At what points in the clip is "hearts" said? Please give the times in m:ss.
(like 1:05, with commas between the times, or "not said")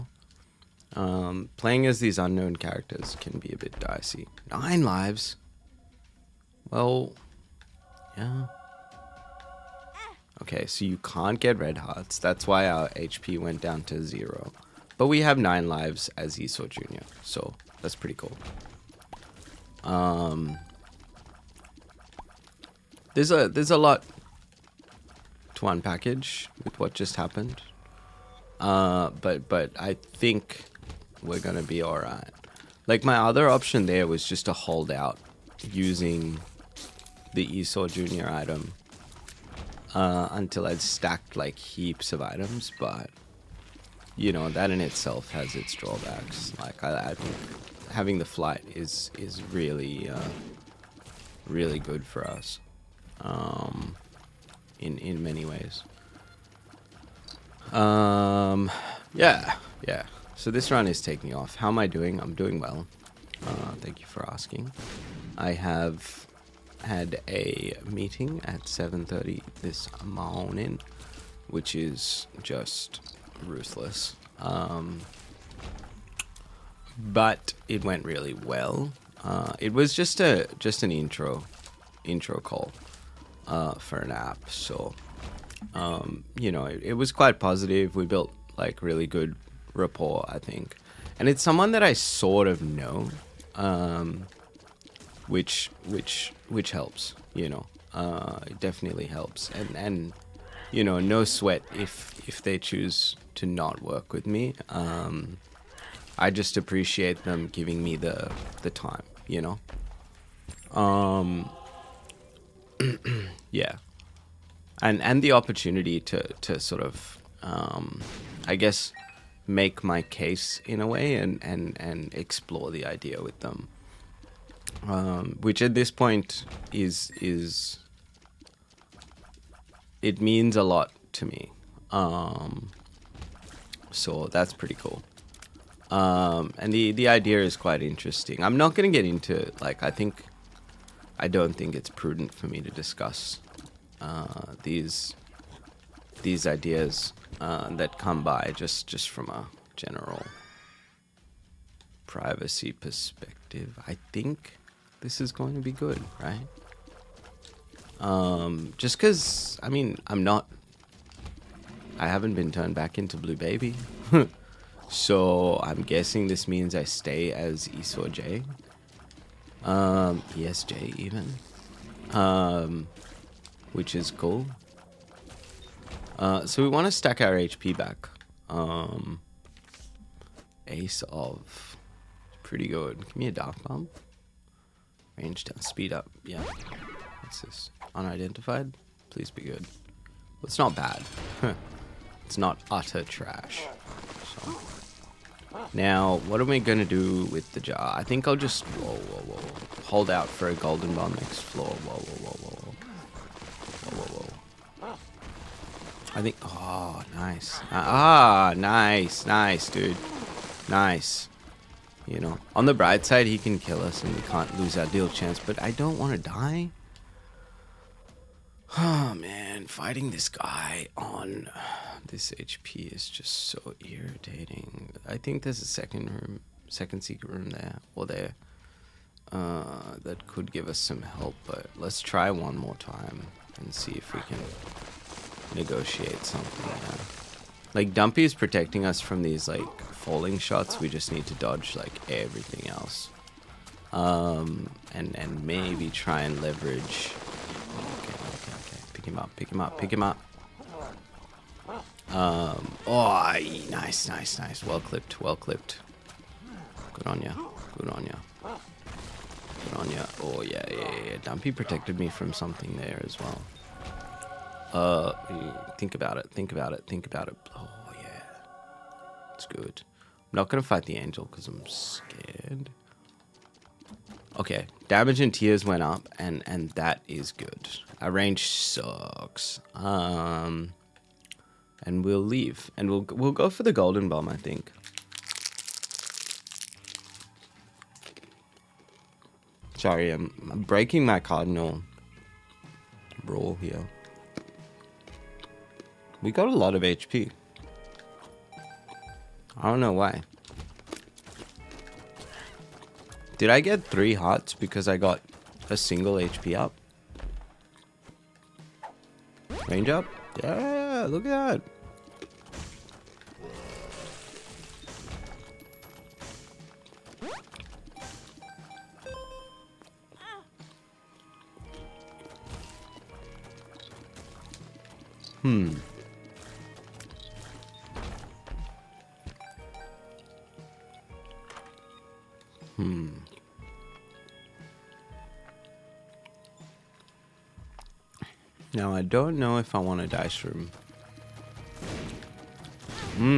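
0:11, 5:04.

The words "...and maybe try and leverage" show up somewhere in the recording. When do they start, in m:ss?
4:05.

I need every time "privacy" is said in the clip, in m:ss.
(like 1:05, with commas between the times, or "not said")
2:32.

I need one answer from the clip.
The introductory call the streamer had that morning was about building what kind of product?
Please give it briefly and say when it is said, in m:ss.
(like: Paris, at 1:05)
An app, at 1:23.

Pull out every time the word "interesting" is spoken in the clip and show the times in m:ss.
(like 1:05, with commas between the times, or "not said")
2:17.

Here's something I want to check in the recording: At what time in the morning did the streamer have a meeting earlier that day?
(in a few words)
7.30.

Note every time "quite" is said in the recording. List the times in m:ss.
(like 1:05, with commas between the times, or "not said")
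1:27, 2:17.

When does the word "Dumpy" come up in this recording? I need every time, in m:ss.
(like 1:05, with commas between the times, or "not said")
3:57, 4:21.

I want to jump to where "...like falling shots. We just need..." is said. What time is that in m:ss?
3:59.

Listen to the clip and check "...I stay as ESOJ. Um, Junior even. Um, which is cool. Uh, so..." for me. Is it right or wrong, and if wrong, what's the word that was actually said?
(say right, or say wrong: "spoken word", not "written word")
wrong: "ESJ", not "Junior".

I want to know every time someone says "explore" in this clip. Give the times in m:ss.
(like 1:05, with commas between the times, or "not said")
2:02.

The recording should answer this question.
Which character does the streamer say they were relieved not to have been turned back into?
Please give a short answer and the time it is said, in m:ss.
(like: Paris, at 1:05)
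Blue Baby, at 2:43.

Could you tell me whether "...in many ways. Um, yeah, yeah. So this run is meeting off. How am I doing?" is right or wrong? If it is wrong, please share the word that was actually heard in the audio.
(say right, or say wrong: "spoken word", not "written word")
wrong: "taking", not "meeting".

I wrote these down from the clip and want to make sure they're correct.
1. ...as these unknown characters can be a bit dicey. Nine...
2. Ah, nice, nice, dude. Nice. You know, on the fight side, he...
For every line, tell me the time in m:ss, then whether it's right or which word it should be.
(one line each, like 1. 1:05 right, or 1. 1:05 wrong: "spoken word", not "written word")
1. 0:01 right
2. 3:27 wrong: "bright", not "fight".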